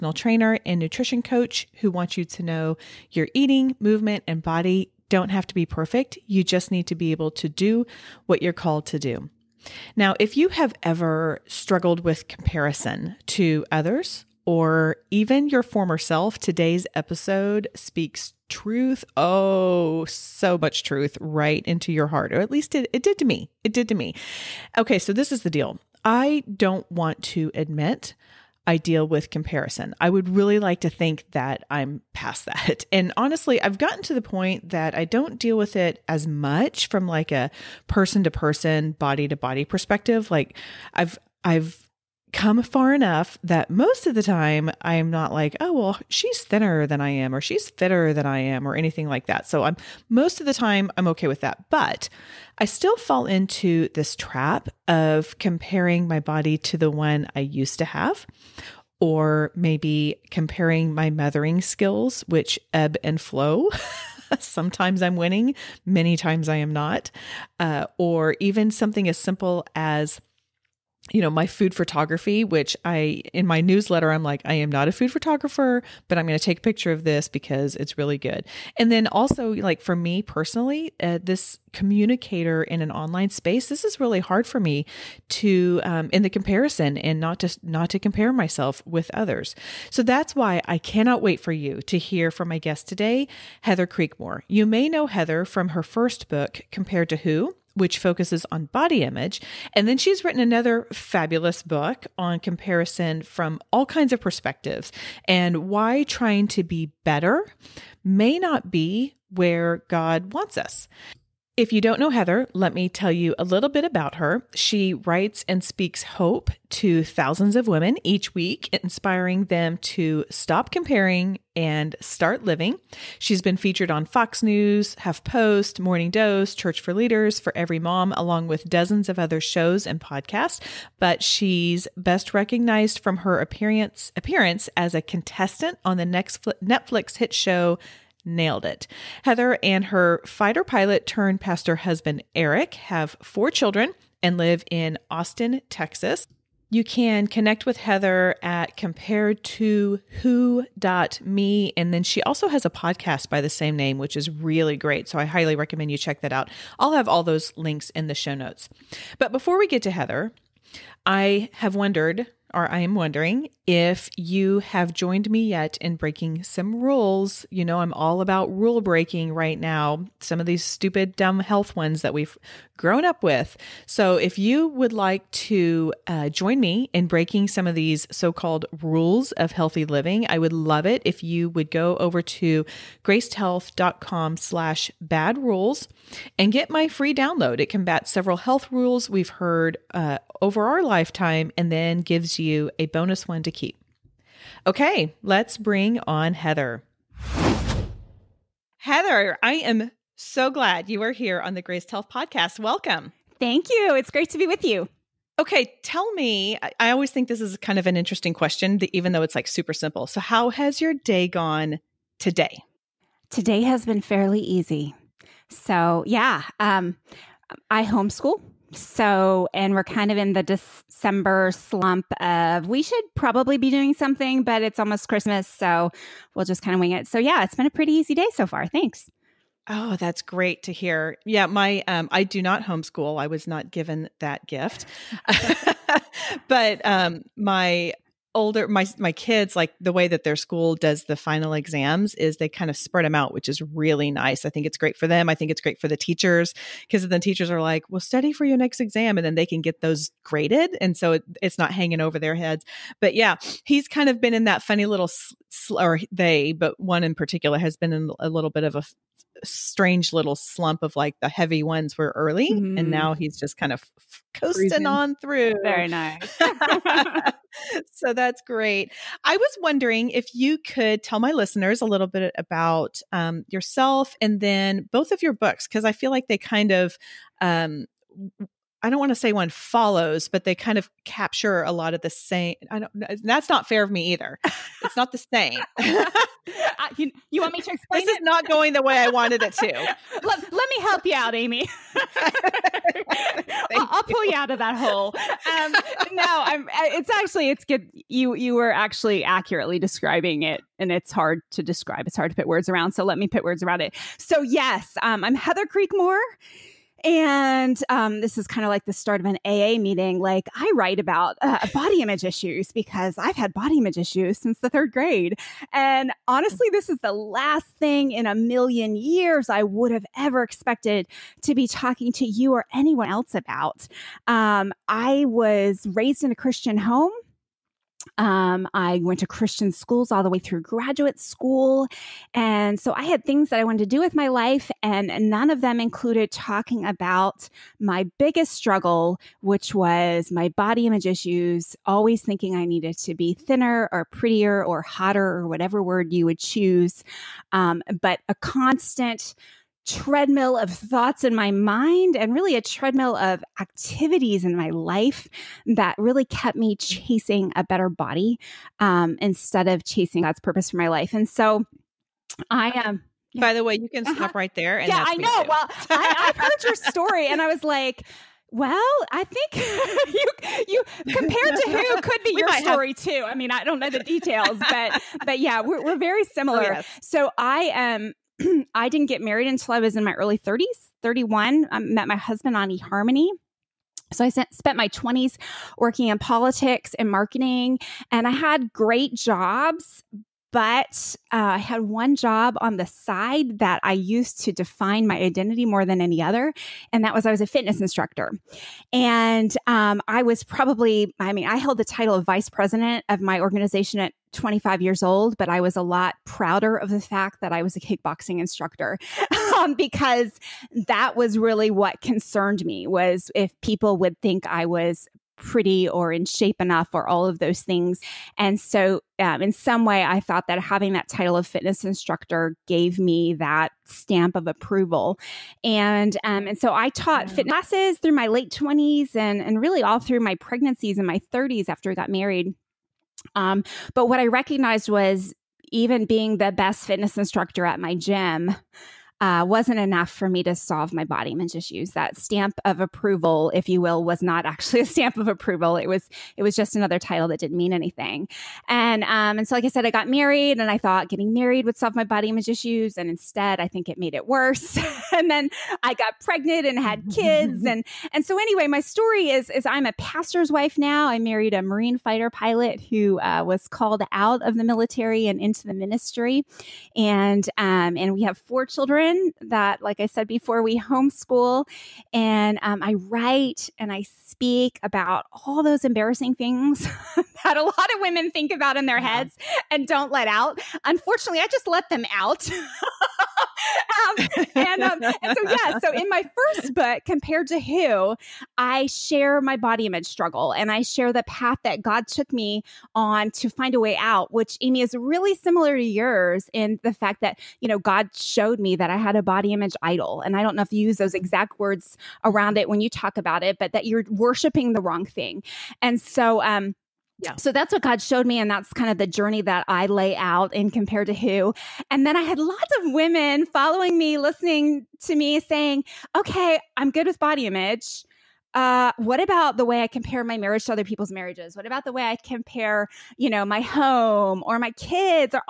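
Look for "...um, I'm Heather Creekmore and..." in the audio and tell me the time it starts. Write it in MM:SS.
05:04.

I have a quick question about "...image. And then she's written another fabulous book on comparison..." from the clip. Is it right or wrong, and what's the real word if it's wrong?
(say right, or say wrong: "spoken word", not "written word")
right.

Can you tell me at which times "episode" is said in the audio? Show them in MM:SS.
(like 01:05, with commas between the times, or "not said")
00:16.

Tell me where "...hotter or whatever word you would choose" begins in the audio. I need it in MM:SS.
05:44.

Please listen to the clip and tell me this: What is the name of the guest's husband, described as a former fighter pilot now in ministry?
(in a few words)
Eric.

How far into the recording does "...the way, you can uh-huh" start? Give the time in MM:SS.
06:03.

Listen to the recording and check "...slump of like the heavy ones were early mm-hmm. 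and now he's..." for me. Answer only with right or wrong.
right.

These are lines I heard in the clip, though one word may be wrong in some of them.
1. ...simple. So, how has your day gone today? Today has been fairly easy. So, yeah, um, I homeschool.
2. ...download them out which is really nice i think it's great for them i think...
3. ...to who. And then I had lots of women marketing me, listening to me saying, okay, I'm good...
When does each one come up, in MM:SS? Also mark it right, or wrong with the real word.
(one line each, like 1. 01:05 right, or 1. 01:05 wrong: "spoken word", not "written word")
1. 03:29 right
2. 04:02 wrong: "spread", not "download"
3. 08:31 wrong: "following", not "marketing".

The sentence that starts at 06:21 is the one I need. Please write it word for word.
I met my husband on eHarmony.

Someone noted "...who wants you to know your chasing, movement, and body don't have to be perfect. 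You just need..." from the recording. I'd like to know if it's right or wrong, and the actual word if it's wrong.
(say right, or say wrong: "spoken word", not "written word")
wrong: "eating", not "chasing".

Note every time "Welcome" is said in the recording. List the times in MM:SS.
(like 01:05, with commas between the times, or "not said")
03:22.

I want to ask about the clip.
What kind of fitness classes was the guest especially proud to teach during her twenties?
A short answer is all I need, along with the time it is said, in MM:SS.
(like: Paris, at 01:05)
kickboxing, at 06:47.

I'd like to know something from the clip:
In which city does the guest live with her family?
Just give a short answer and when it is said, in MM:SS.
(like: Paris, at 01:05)
Austin, Texas, at 02:25.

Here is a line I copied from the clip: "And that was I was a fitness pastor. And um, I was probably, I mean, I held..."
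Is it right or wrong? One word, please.
wrong.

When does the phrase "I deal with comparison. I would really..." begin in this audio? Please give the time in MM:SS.
00:28.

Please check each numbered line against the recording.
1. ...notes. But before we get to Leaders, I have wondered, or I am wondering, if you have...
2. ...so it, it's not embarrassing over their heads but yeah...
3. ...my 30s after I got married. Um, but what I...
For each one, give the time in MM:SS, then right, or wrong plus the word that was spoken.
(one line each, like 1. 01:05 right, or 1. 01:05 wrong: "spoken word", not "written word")
1. 02:38 wrong: "Heather", not "Leaders"
2. 04:10 wrong: "hanging", not "embarrassing"
3. 07:11 right.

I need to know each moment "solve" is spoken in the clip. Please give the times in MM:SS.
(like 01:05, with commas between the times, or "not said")
07:20, 07:31.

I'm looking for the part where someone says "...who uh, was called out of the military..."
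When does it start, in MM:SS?
07:42.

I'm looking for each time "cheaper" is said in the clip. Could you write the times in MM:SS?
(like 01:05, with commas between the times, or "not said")
not said.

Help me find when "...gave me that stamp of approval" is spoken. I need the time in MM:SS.
07:02.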